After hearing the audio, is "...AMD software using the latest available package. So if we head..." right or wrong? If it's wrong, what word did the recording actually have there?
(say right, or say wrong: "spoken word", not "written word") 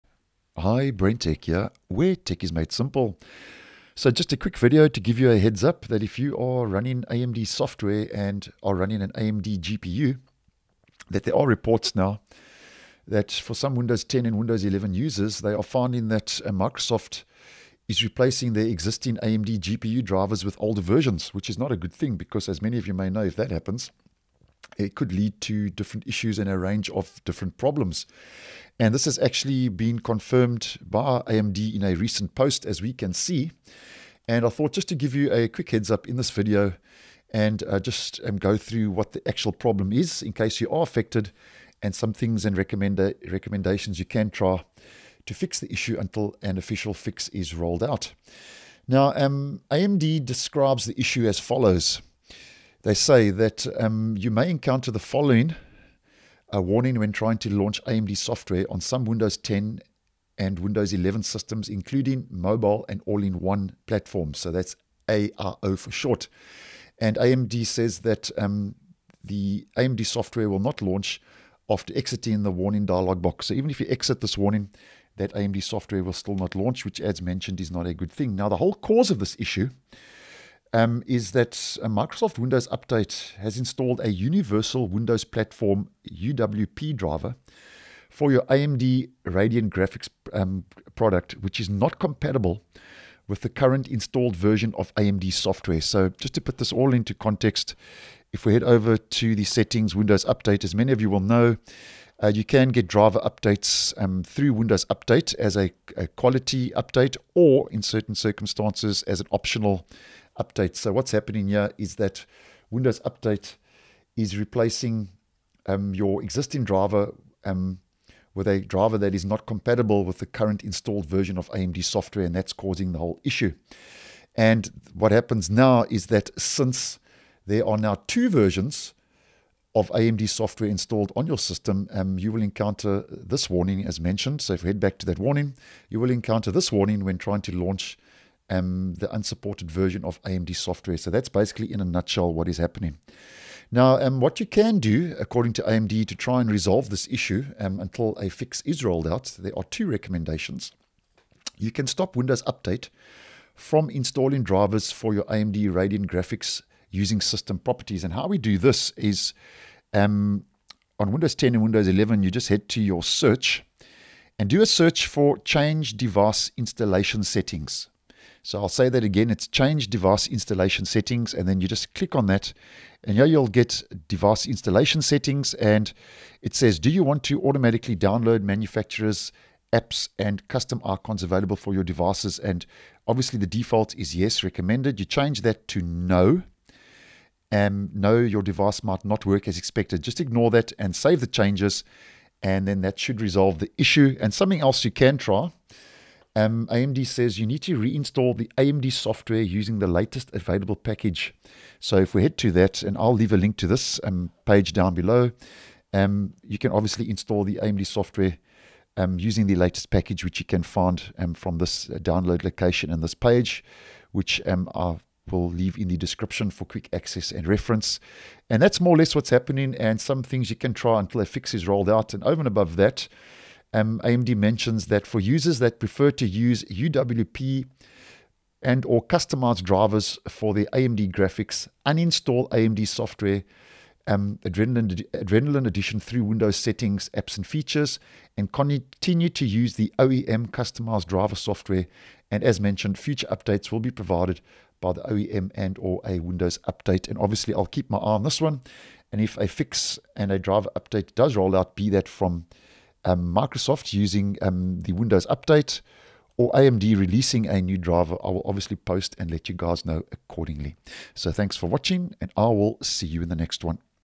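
right.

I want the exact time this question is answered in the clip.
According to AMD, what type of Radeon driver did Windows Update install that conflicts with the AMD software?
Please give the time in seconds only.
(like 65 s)
84 s.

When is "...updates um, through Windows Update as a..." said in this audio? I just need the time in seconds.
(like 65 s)
103 s.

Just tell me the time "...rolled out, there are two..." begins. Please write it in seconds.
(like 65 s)
148 s.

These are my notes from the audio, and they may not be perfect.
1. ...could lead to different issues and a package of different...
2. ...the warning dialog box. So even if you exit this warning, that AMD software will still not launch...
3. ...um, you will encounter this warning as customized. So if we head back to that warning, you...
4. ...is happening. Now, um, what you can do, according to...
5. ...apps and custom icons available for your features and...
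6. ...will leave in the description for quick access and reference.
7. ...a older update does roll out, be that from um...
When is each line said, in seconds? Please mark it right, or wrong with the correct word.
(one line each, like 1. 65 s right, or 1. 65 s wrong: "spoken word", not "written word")
1. 24 s wrong: "range", not "package"
2. 72 s right
3. 131 s wrong: "mentioned", not "customized"
4. 142 s right
5. 179 s wrong: "devices", not "features"
6. 215 s right
7. 250 s wrong: "driver", not "older".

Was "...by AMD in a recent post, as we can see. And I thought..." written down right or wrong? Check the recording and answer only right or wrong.
right.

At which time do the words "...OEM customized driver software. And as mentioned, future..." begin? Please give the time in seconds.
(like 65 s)
239 s.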